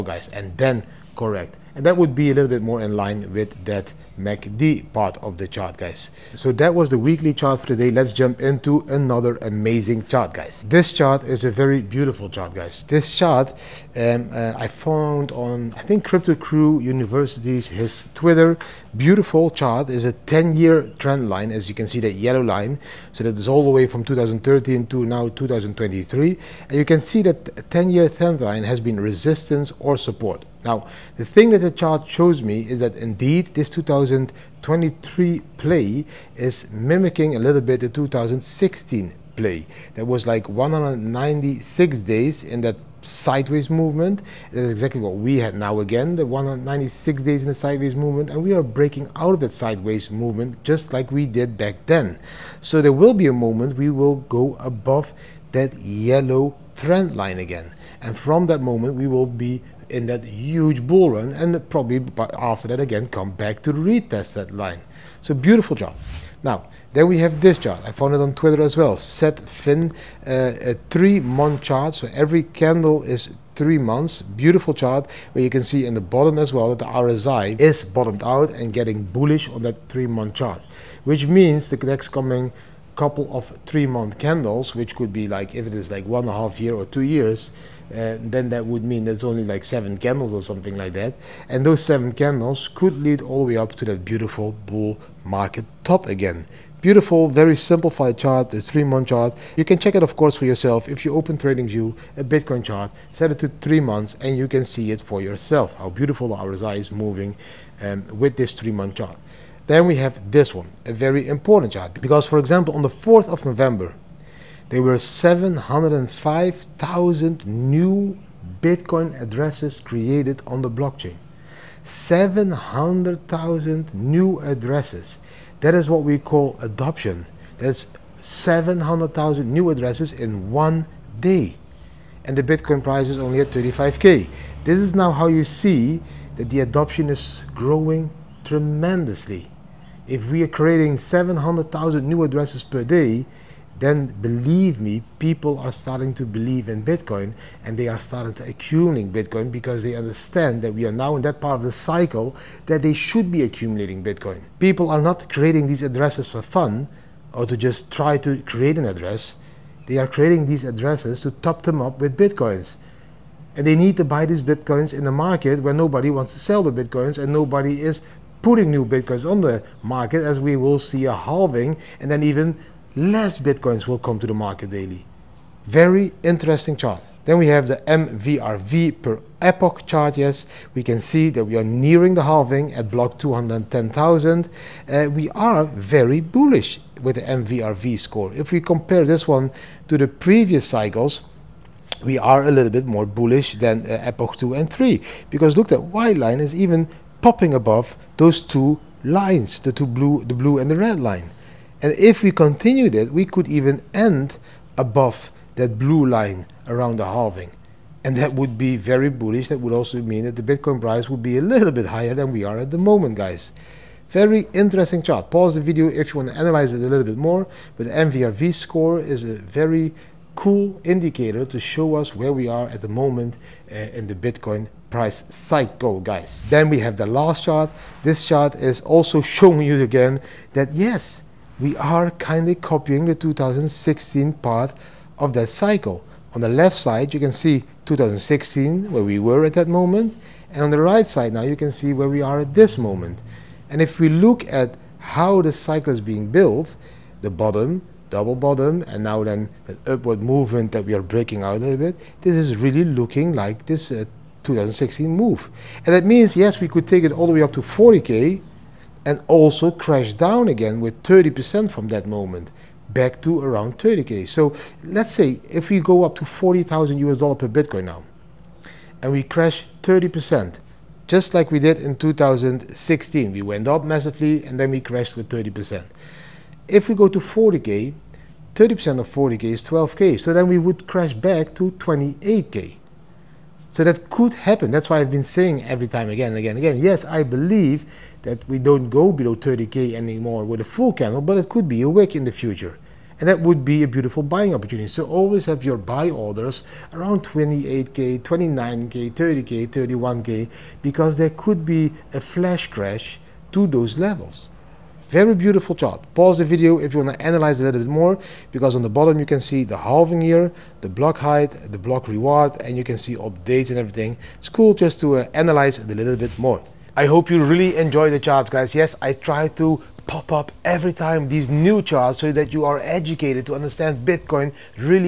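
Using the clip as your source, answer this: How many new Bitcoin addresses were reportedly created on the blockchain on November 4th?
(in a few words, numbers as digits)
705,000.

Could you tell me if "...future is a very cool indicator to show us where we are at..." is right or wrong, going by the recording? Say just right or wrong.
wrong.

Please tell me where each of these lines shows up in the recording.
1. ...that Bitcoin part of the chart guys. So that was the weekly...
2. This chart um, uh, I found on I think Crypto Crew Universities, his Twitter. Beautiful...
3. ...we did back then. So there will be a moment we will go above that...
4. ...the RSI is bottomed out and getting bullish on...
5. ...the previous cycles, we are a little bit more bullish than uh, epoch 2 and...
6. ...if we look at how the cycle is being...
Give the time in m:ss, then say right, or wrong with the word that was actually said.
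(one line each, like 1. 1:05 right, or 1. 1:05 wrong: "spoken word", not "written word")
1. 0:03 wrong: "MACD", not "Bitcoin"
2. 0:12 right
3. 0:51 right
4. 1:16 right
5. 3:09 right
6. 4:03 right.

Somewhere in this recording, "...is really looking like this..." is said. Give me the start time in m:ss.
4:12.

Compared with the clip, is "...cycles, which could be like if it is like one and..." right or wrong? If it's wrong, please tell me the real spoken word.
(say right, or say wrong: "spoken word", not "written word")
wrong: "candles", not "cycles".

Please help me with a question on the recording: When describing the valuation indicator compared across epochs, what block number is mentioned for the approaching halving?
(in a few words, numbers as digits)
210,000.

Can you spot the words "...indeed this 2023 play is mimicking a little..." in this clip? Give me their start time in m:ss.
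0:32.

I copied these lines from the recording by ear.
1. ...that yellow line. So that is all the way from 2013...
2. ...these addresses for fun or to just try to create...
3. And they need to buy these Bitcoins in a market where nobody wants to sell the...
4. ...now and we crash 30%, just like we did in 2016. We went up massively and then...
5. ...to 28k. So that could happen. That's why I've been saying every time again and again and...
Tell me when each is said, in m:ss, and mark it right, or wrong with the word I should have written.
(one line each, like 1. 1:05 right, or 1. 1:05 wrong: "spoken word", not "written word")
1. 0:21 right
2. 2:35 right
3. 2:43 right
4. 4:27 right
5. 4:41 right.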